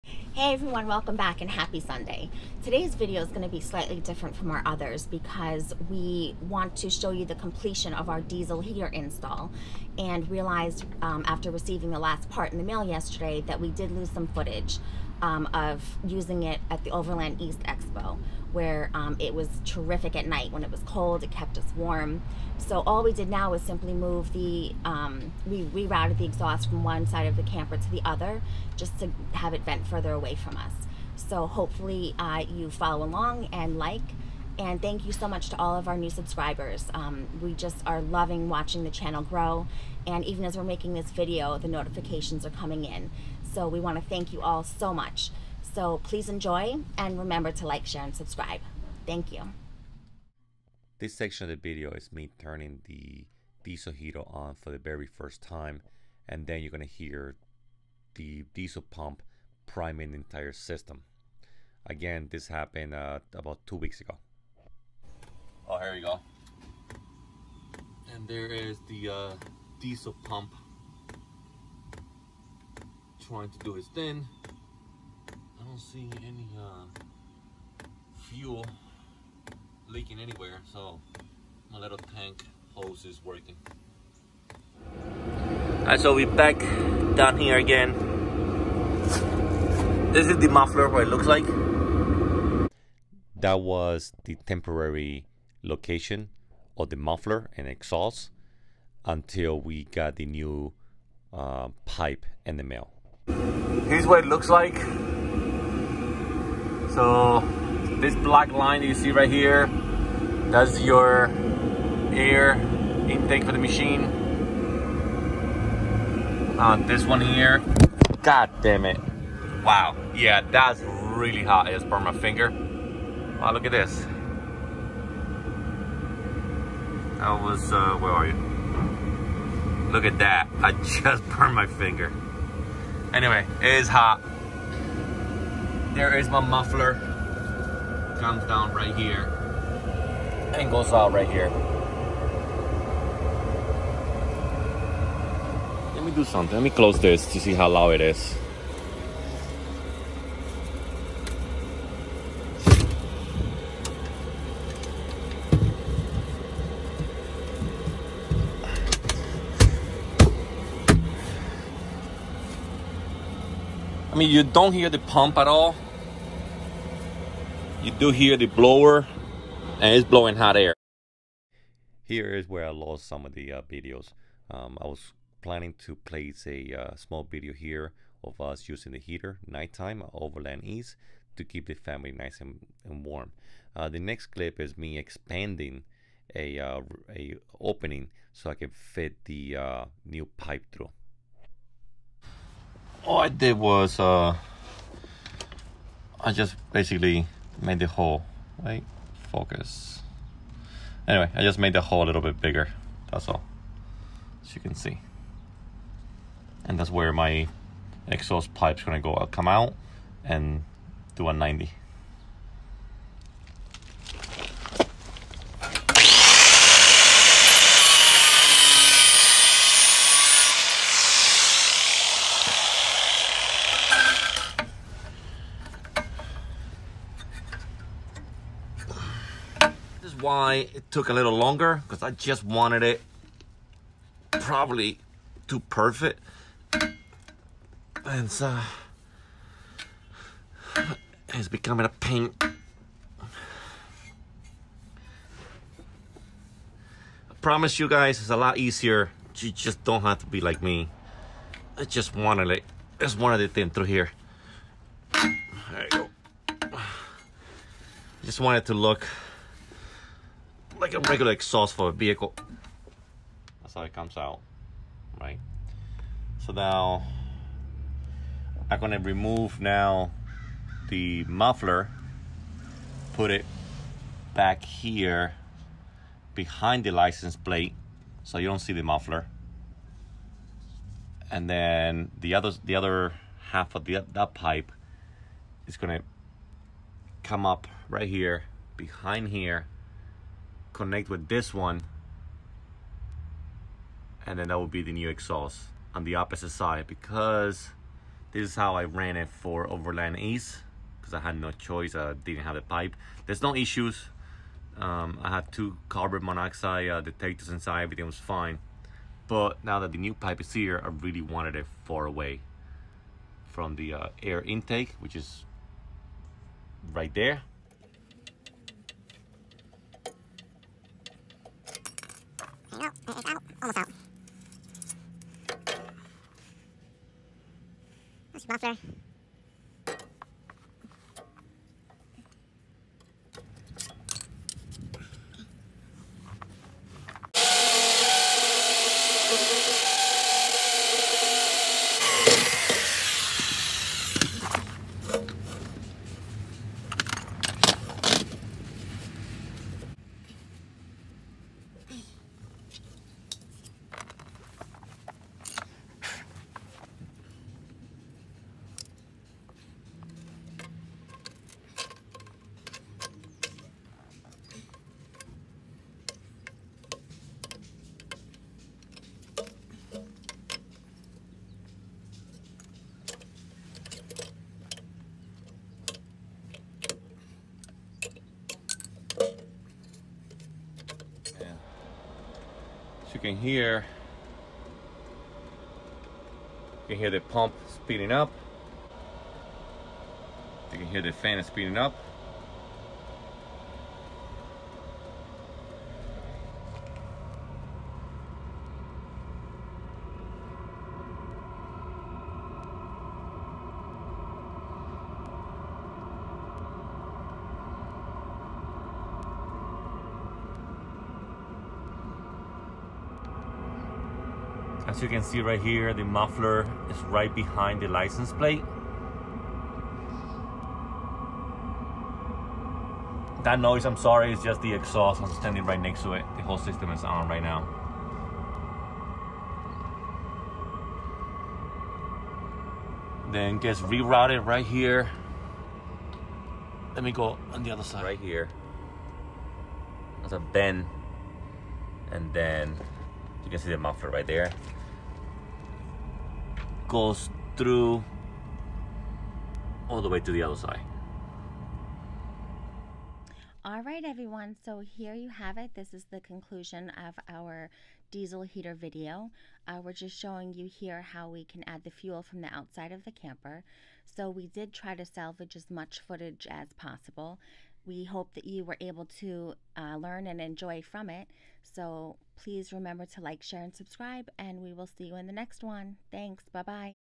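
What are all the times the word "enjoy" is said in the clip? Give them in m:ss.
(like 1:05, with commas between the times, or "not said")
0:46, 7:50.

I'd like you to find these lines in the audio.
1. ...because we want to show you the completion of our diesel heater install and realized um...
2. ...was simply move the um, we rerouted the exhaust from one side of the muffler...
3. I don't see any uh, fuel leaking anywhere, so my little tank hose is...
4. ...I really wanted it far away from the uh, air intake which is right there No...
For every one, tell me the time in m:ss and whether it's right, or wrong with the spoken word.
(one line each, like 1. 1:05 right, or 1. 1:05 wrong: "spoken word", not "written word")
1. 0:05 right
2. 0:23 wrong: "camper", not "muffler"
3. 1:15 right
4. 5:10 right.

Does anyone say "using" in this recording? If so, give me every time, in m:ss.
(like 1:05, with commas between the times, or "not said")
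0:16, 2:58.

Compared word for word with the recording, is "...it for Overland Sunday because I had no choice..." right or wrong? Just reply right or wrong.
wrong.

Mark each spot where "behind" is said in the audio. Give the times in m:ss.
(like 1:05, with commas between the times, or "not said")
4:36, 4:48, 6:57.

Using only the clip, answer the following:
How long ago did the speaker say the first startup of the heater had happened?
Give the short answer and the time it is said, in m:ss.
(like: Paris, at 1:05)
about two weeks, at 1:03.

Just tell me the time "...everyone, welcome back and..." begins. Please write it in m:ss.
0:00.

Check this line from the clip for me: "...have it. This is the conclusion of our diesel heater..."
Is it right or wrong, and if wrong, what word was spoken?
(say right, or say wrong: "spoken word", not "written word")
right.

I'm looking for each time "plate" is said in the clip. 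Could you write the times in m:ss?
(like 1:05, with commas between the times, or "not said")
4:37, 6:58.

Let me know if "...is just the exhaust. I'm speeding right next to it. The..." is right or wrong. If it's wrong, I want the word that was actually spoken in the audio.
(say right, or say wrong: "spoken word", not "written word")
wrong: "standing", not "speeding".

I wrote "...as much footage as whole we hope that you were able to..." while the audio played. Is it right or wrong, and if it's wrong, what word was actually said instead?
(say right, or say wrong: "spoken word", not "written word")
wrong: "possible", not "whole".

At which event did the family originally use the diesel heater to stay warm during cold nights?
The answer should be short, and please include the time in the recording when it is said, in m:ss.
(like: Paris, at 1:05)
Overland East Expo, at 0:16.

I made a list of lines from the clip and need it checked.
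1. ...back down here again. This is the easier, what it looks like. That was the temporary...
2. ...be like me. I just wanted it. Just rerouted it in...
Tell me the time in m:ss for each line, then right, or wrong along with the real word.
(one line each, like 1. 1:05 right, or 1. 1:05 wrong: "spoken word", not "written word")
1. 1:26 wrong: "muffler", not "easier"
2. 4:10 wrong: "wanted", not "rerouted".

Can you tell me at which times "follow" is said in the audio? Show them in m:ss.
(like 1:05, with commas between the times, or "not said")
0:32.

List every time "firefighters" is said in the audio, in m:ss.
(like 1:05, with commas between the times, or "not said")
not said.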